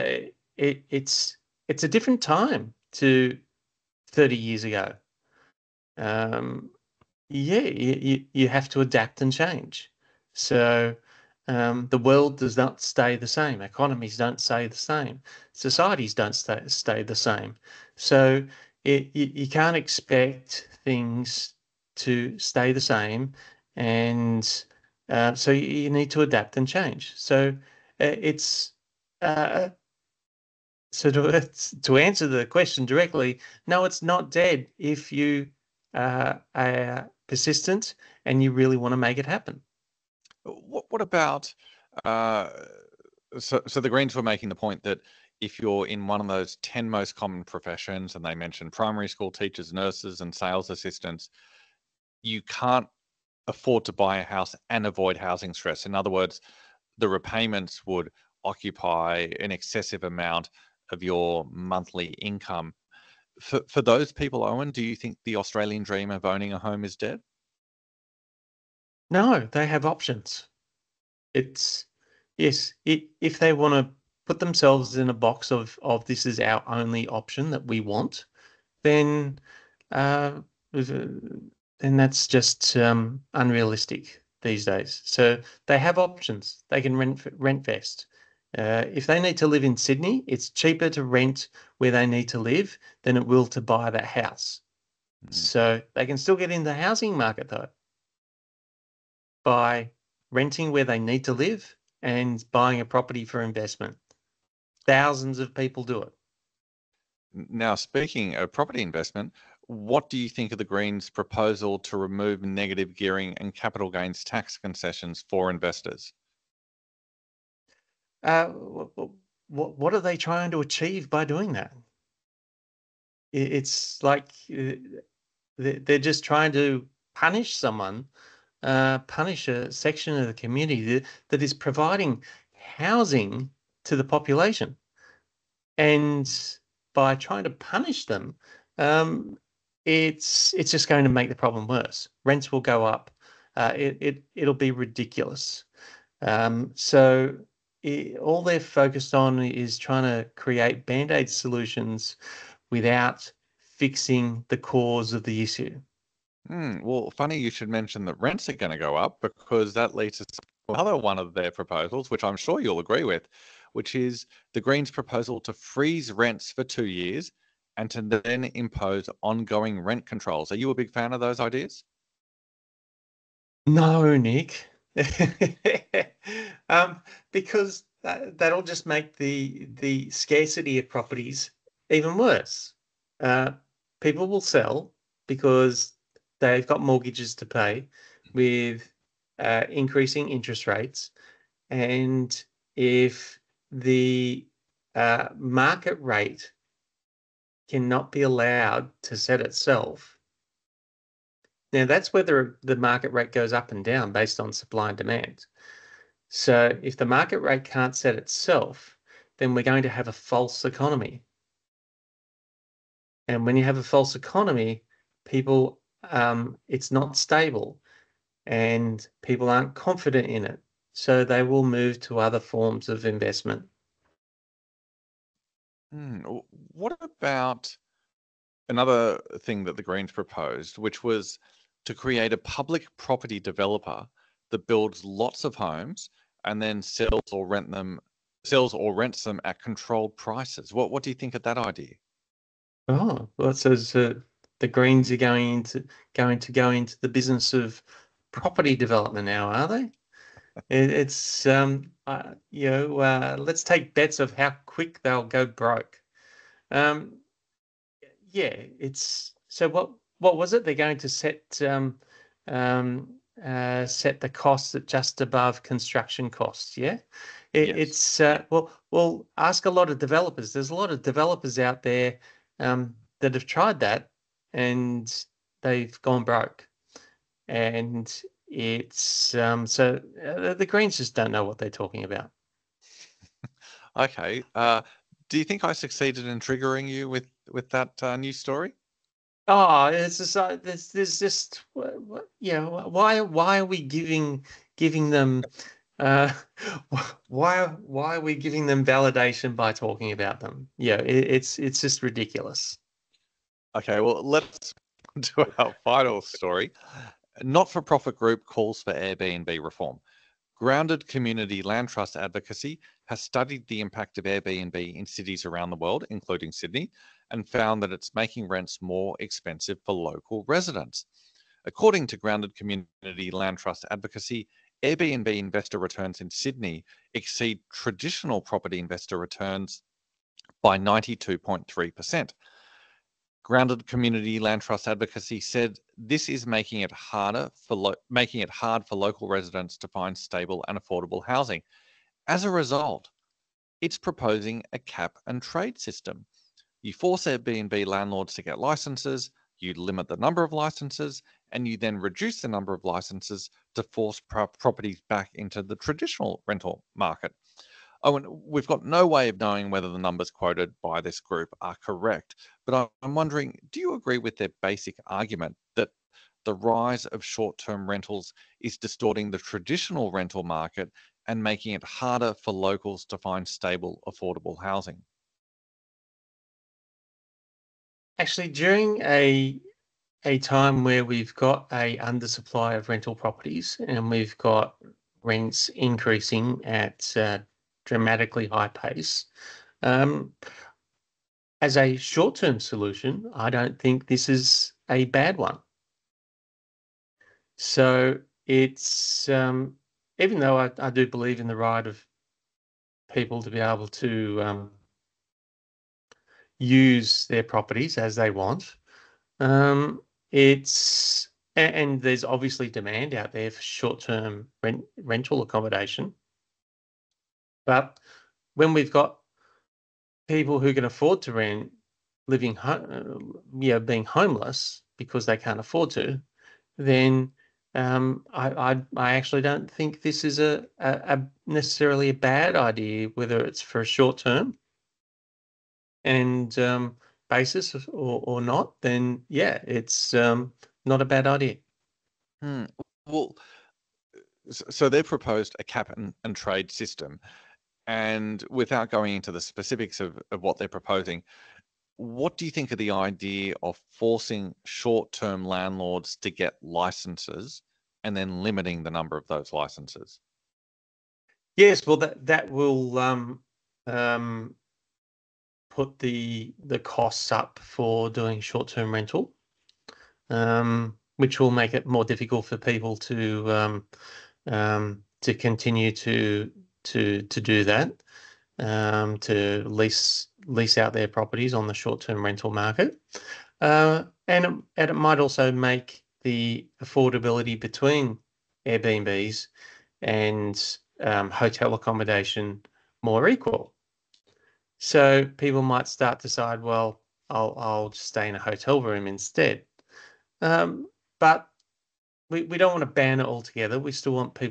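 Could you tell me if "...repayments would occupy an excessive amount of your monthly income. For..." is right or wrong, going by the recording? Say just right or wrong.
right.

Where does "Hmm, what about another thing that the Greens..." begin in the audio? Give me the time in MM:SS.
03:45.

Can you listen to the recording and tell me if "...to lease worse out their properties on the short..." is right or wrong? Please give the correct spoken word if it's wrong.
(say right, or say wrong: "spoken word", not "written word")
wrong: "lease", not "worse".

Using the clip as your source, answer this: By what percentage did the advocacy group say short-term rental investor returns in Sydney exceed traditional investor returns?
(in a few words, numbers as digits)
92.3%.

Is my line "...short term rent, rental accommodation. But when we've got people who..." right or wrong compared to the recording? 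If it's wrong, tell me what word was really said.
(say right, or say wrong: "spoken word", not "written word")
right.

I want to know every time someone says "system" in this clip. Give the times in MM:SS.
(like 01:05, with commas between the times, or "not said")
05:45, 07:26.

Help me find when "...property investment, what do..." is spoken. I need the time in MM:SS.
01:48.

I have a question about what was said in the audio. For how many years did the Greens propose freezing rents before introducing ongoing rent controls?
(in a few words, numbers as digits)
2.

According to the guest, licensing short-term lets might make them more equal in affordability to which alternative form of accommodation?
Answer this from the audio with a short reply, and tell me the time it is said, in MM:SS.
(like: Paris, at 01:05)
hotel accommodation, at 08:11.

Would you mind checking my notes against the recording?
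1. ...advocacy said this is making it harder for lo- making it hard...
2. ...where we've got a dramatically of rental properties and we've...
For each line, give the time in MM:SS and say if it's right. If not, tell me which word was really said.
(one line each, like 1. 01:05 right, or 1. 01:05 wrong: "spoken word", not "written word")
1. 05:34 right
2. 06:20 wrong: "undersupply", not "dramatically".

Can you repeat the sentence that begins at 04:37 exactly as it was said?
And it's um, so uh, the Greens just don't know what they're talking about.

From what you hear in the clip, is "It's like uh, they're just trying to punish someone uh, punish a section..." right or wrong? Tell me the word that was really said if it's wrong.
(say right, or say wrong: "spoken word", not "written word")
right.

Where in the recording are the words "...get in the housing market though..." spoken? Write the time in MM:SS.
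01:36.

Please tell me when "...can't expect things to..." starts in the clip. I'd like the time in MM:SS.
00:19.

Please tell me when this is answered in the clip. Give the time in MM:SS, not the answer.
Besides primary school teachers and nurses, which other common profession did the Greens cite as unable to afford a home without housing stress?
00:50.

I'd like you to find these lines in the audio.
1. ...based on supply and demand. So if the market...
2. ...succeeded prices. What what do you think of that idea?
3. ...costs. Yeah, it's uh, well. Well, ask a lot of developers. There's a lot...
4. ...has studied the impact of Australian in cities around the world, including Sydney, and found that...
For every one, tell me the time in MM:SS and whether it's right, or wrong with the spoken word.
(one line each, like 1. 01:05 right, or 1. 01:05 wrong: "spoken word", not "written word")
1. 03:24 right
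2. 03:59 wrong: "controlled", not "succeeded"
3. 04:26 right
4. 05:13 wrong: "Airbnb", not "Australian".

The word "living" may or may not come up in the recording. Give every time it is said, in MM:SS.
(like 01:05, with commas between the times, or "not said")
07:02.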